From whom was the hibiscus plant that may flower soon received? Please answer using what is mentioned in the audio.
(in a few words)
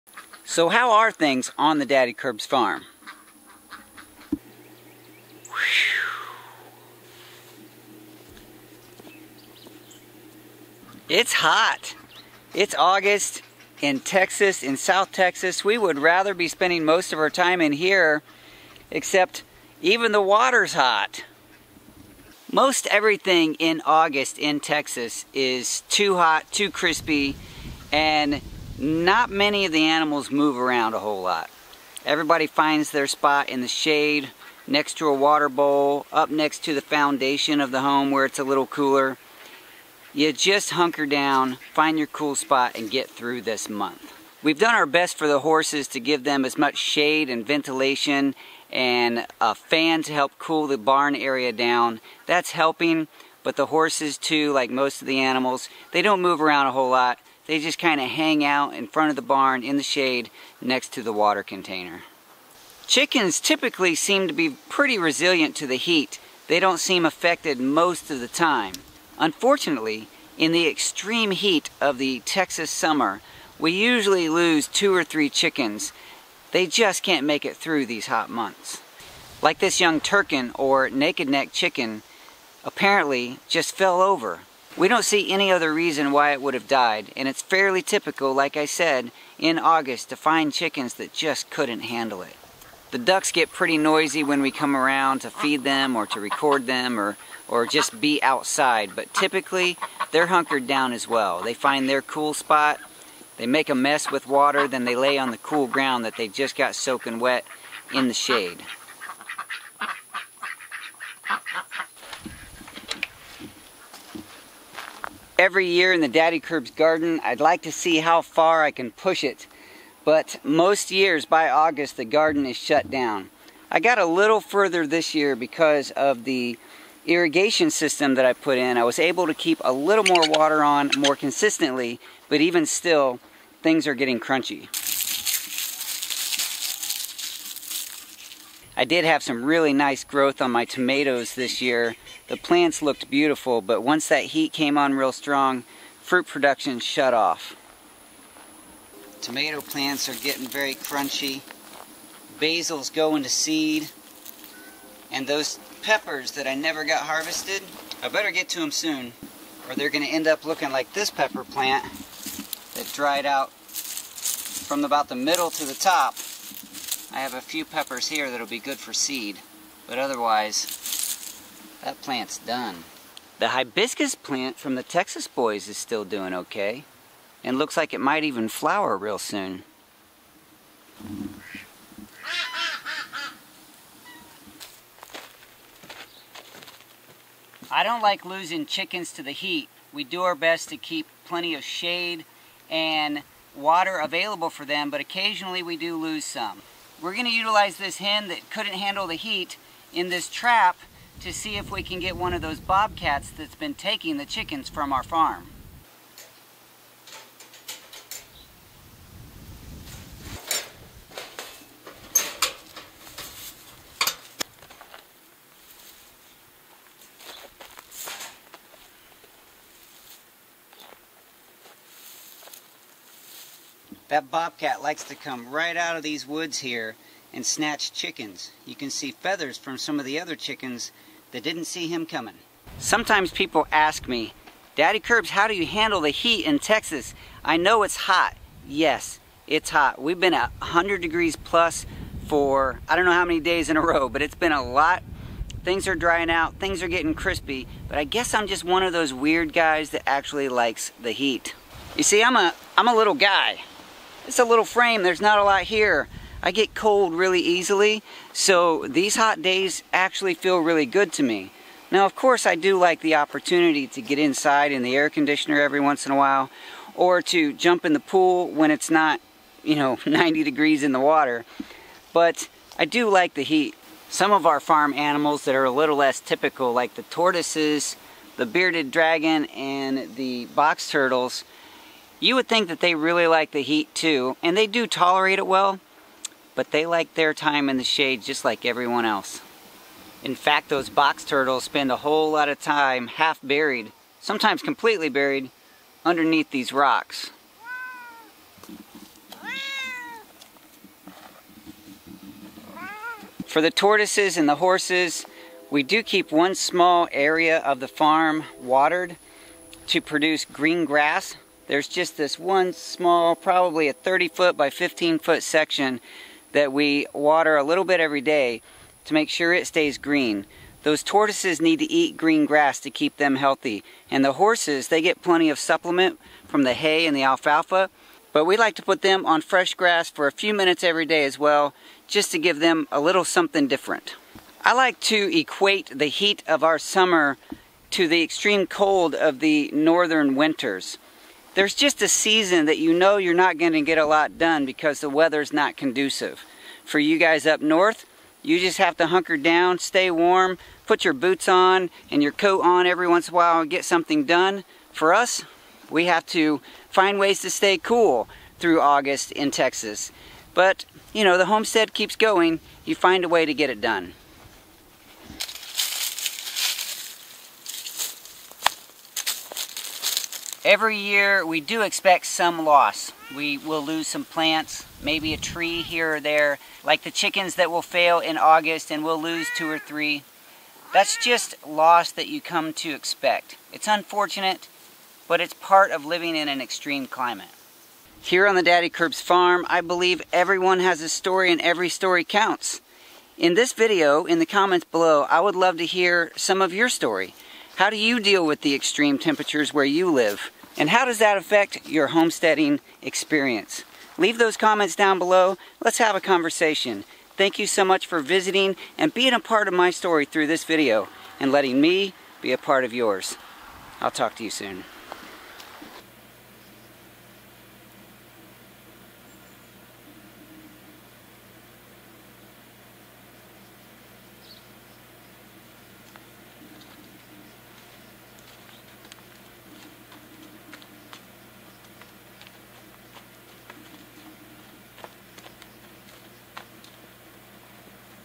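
the Texas boys.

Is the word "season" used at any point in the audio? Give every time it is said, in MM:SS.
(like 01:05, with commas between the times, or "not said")
05:42.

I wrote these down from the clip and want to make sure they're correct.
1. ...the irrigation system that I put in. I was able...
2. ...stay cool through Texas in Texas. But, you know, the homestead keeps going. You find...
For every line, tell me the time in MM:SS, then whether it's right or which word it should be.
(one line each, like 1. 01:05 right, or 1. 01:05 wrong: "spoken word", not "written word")
1. 02:06 right
2. 05:57 wrong: "August", not "Texas".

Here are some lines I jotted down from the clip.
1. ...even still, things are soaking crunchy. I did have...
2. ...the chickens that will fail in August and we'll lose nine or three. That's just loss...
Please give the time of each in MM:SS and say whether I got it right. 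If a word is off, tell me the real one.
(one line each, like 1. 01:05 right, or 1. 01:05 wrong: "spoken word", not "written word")
1. 02:12 wrong: "getting", not "soaking"
2. 06:17 wrong: "two", not "nine".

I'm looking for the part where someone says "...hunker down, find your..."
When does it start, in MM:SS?
00:40.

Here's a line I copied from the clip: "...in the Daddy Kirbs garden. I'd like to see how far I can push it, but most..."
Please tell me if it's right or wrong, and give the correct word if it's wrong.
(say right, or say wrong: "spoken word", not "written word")
right.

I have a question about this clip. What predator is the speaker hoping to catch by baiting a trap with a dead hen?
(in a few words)
bobcat.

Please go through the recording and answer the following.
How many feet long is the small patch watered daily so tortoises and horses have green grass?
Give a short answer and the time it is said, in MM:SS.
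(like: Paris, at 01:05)
30 feet, at 05:13.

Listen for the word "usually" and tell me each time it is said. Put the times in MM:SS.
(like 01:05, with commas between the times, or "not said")
01:13.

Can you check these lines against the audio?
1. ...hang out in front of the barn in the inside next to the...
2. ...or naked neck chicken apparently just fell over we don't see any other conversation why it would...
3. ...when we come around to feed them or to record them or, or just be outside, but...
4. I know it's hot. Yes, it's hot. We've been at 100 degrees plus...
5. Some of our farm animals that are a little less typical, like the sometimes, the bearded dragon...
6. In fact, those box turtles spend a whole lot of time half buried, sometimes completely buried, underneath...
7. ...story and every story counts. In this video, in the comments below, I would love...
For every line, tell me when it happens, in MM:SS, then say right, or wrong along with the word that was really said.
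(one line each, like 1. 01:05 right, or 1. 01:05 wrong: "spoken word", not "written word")
1. 00:58 wrong: "shade", not "inside"
2. 01:20 wrong: "reason", not "conversation"
3. 01:34 right
4. 03:57 right
5. 04:34 wrong: "tortoises", not "sometimes"
6. 04:50 right
7. 06:31 right.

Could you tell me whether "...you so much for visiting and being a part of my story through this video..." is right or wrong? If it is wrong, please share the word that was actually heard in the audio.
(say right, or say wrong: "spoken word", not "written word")
right.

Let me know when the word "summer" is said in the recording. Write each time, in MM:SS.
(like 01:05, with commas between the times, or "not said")
01:12, 05:36.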